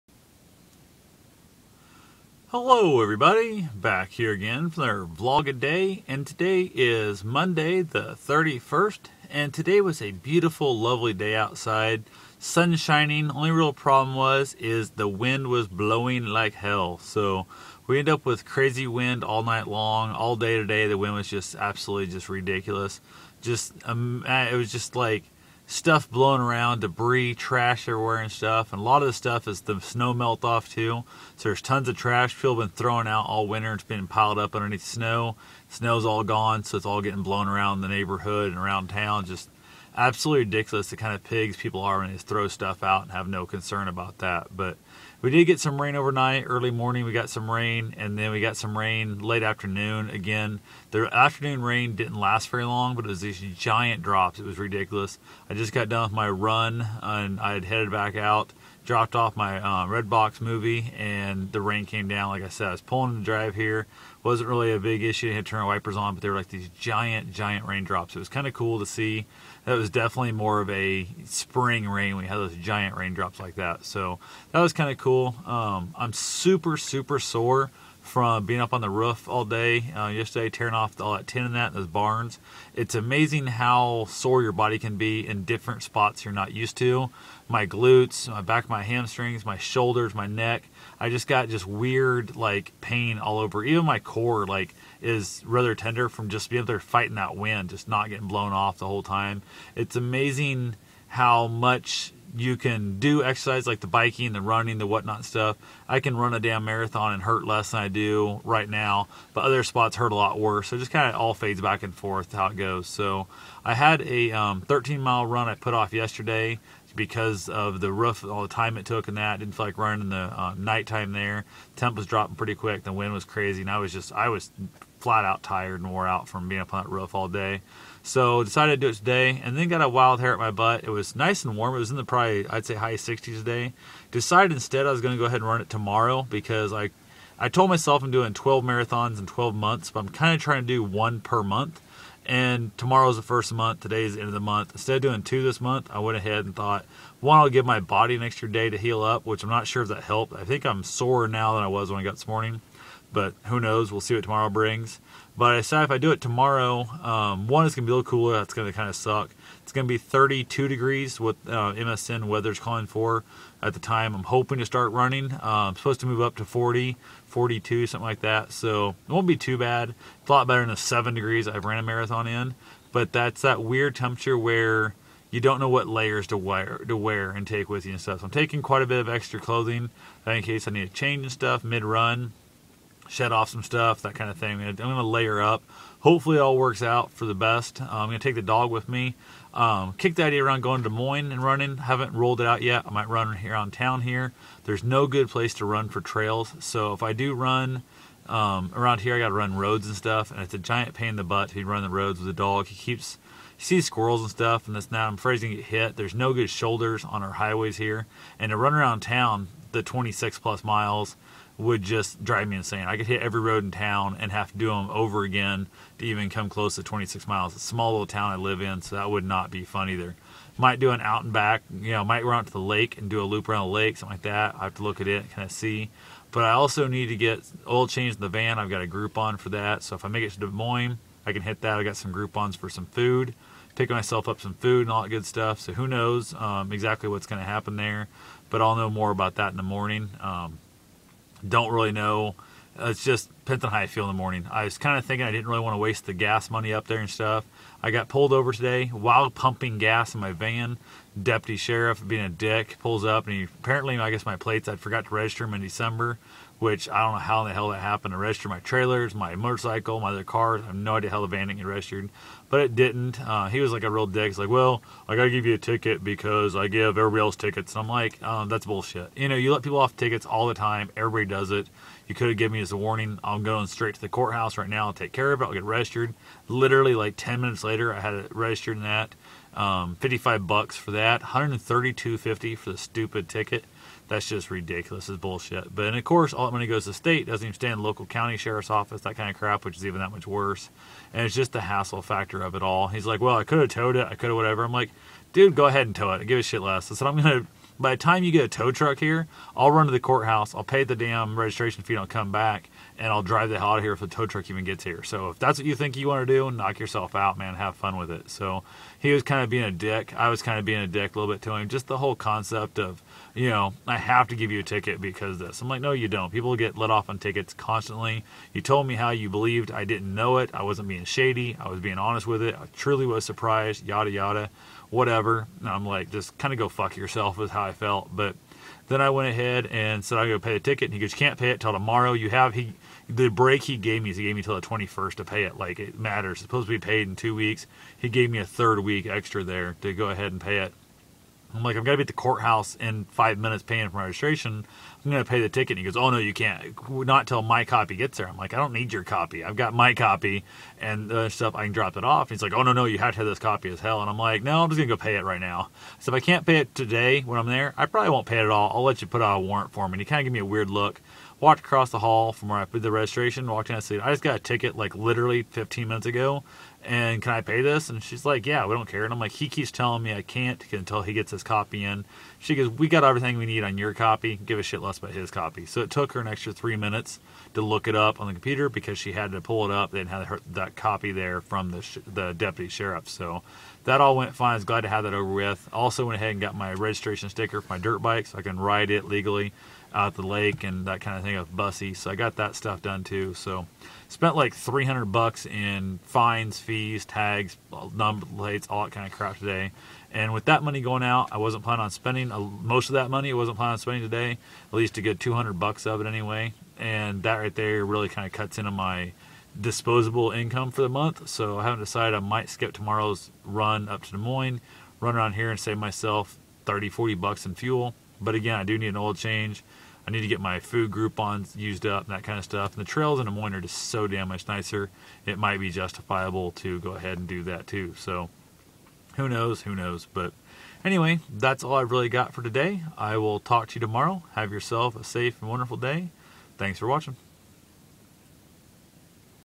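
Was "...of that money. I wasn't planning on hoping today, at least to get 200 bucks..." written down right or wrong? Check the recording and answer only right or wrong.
wrong.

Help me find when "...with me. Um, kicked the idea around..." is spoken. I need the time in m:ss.
3:08.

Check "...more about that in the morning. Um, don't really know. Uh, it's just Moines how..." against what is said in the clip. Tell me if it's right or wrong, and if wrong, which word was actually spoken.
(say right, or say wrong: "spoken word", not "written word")
wrong: "Penton", not "Moines".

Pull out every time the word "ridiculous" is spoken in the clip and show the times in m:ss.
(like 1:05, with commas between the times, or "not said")
0:22, 0:40, 0:54, 4:44.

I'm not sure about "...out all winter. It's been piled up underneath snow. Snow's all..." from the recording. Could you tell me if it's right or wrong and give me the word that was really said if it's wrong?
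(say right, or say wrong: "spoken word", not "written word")
right.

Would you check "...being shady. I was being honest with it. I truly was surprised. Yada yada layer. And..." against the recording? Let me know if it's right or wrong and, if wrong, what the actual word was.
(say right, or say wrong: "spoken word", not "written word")
wrong: "whatever", not "layer".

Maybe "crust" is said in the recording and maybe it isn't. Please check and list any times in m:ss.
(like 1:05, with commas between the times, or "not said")
not said.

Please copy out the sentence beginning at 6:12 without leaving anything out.
She goes, we got everything we need on your copy.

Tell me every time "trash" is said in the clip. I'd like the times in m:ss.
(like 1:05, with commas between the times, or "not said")
0:27, 0:31.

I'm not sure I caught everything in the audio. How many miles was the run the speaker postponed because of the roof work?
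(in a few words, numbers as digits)
13.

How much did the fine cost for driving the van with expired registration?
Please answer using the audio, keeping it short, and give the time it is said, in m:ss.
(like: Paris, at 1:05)
$132.50, at 4:41.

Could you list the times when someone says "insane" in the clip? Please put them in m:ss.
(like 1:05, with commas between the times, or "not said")
3:32.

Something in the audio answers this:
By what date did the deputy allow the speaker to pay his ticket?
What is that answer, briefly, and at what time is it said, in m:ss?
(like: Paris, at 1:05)
the 21st, at 5:34.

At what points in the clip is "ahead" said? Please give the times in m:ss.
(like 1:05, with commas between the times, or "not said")
2:15, 2:26, 4:55, 5:29, 5:40, 6:26, 7:06.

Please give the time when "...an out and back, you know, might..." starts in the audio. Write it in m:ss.
3:40.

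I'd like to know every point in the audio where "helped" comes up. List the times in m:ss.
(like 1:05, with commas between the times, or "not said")
2:30.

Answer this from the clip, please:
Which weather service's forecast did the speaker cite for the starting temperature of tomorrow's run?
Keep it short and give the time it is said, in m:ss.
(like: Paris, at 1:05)
MSN weather, at 2:41.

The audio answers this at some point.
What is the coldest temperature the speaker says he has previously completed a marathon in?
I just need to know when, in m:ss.
2:50.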